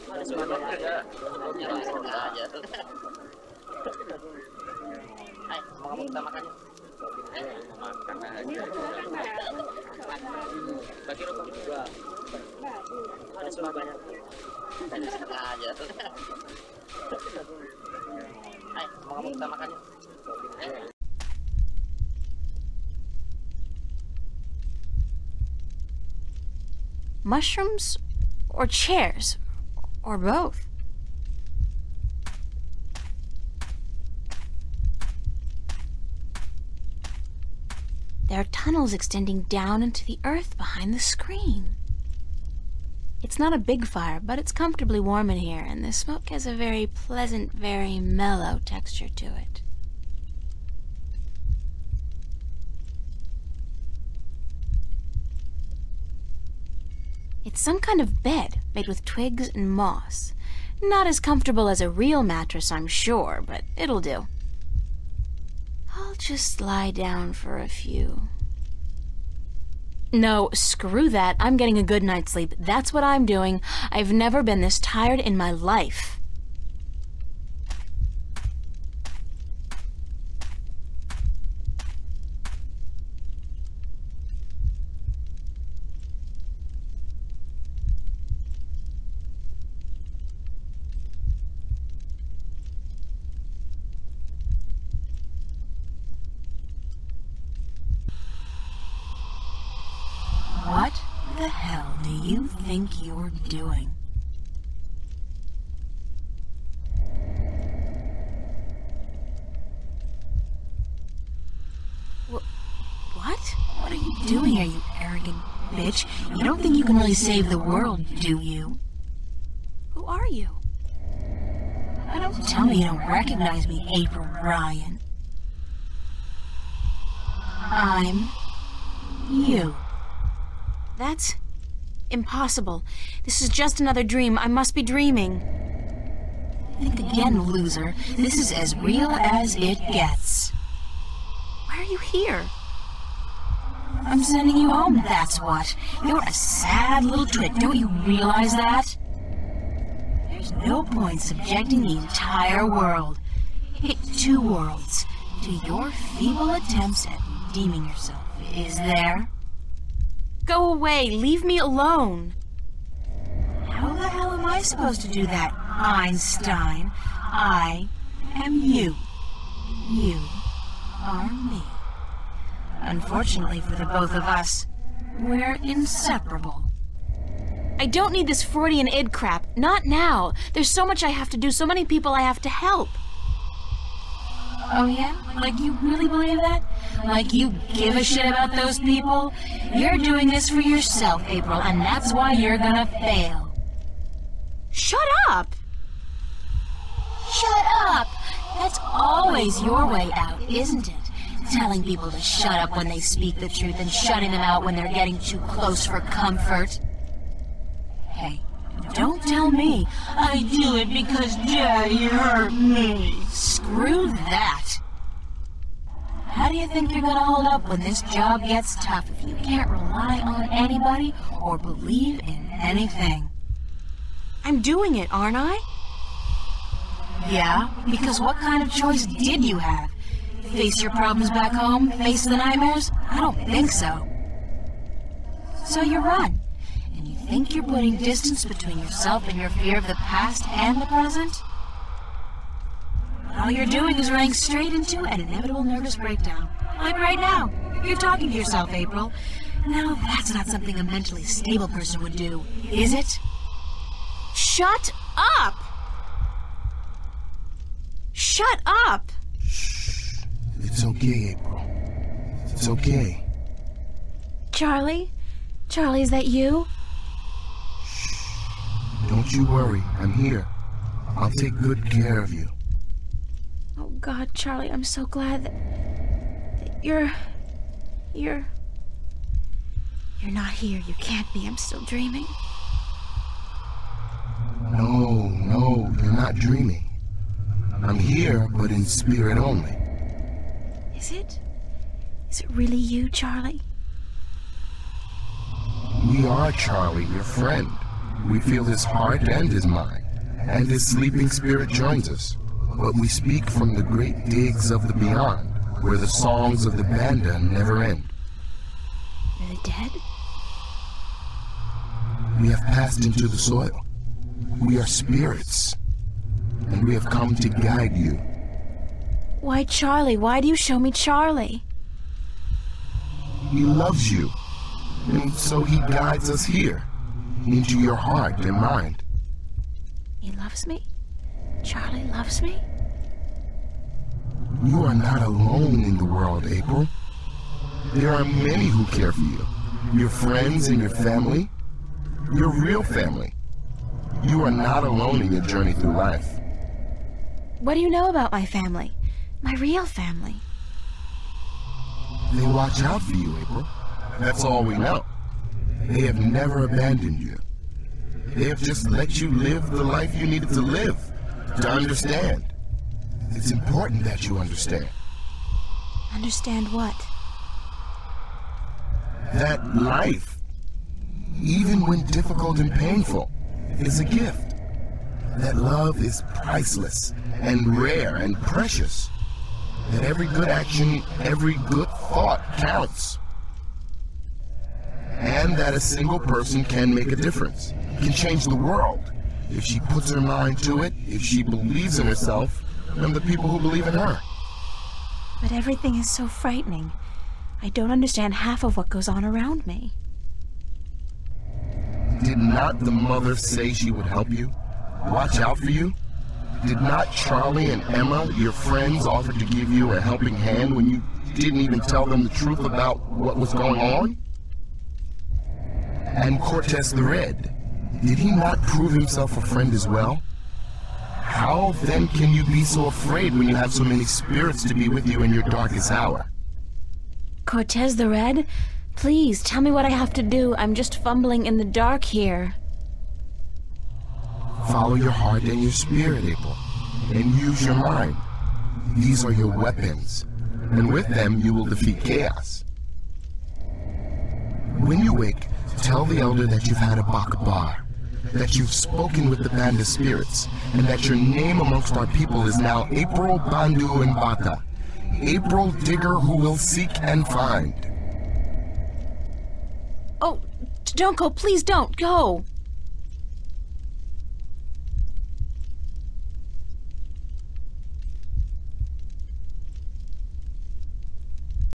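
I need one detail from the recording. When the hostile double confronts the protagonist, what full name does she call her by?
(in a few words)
April Ryan.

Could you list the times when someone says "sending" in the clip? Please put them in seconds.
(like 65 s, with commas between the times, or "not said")
144 s.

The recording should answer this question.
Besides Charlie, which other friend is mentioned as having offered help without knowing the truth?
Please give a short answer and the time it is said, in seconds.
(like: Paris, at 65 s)
Emma, at 407 s.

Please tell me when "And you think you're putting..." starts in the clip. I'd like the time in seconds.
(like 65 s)
236 s.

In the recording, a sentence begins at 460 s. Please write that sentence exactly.
Oh, don't go, please don't, go!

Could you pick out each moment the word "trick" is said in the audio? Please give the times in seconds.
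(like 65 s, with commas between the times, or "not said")
147 s.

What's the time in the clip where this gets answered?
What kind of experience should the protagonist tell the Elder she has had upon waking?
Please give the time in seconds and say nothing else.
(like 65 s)
447 s.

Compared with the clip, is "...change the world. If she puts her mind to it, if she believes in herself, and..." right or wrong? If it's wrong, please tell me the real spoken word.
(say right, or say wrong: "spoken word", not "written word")
right.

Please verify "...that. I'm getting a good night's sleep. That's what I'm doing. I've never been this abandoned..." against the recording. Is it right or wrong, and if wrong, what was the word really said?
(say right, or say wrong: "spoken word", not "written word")
wrong: "tired", not "abandoned".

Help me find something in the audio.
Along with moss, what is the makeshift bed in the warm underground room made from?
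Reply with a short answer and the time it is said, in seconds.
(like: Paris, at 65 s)
Twigs, at 59 s.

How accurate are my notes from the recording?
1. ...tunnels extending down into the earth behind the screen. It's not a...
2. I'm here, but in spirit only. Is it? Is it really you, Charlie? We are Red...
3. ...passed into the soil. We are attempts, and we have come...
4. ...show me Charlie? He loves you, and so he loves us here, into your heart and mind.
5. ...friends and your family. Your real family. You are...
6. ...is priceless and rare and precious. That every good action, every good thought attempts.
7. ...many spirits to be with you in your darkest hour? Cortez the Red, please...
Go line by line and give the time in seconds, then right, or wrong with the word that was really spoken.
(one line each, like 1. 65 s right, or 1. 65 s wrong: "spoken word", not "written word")
1. 38 s right
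2. 287 s wrong: "Charlie", not "Red"
3. 312 s wrong: "spirits", not "attempts"
4. 320 s wrong: "guides", not "loves"
5. 340 s right
6. 376 s wrong: "counts", not "attempts"
7. 423 s right.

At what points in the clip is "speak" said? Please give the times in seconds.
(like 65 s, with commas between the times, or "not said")
202 s, 303 s.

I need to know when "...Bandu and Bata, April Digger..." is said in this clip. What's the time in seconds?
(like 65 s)
453 s.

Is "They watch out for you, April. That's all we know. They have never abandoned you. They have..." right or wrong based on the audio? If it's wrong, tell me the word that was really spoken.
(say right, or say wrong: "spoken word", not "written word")
right.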